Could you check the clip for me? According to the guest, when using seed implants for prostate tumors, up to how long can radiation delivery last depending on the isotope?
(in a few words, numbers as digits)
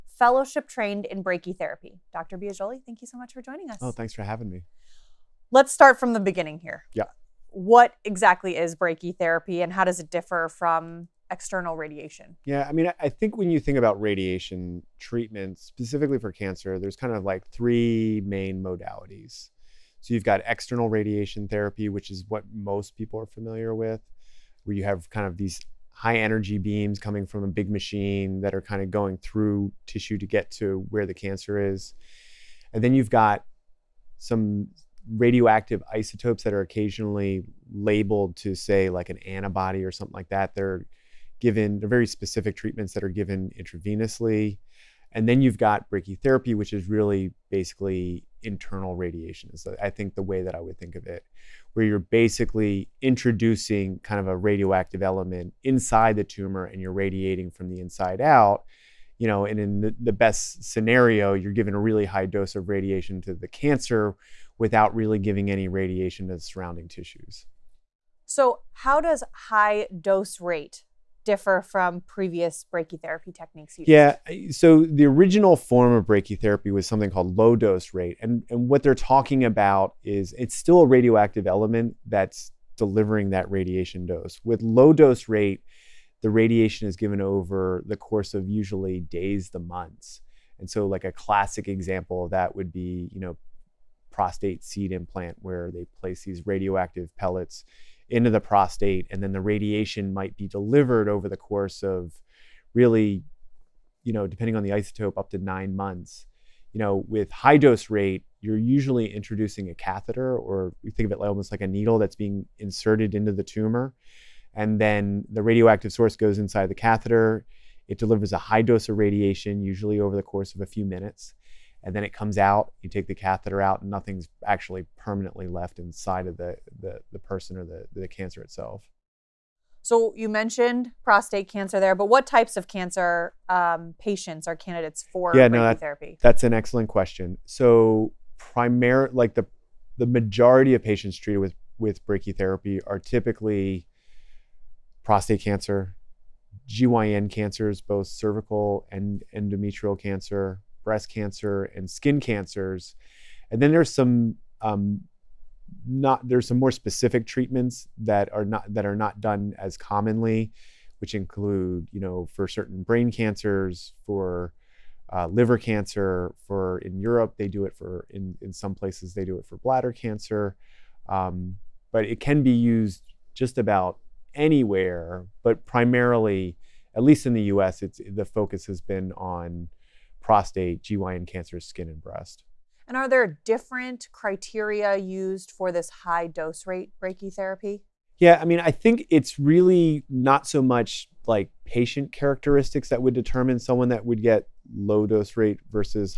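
9 months.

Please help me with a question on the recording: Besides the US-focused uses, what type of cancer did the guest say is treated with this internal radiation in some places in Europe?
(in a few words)
Bladder cancer.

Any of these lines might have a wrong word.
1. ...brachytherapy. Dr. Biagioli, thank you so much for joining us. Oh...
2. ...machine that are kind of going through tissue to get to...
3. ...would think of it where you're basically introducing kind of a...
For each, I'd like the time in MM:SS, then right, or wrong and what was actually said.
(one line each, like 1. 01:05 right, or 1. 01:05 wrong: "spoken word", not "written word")
1. 00:01 right
2. 00:27 right
3. 00:50 right.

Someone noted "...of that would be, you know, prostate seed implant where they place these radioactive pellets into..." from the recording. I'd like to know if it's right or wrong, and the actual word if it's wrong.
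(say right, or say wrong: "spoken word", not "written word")
right.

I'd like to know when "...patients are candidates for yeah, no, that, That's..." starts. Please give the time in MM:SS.
02:13.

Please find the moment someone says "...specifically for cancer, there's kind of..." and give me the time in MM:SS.
00:15.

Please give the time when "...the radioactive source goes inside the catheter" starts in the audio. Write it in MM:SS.
01:55.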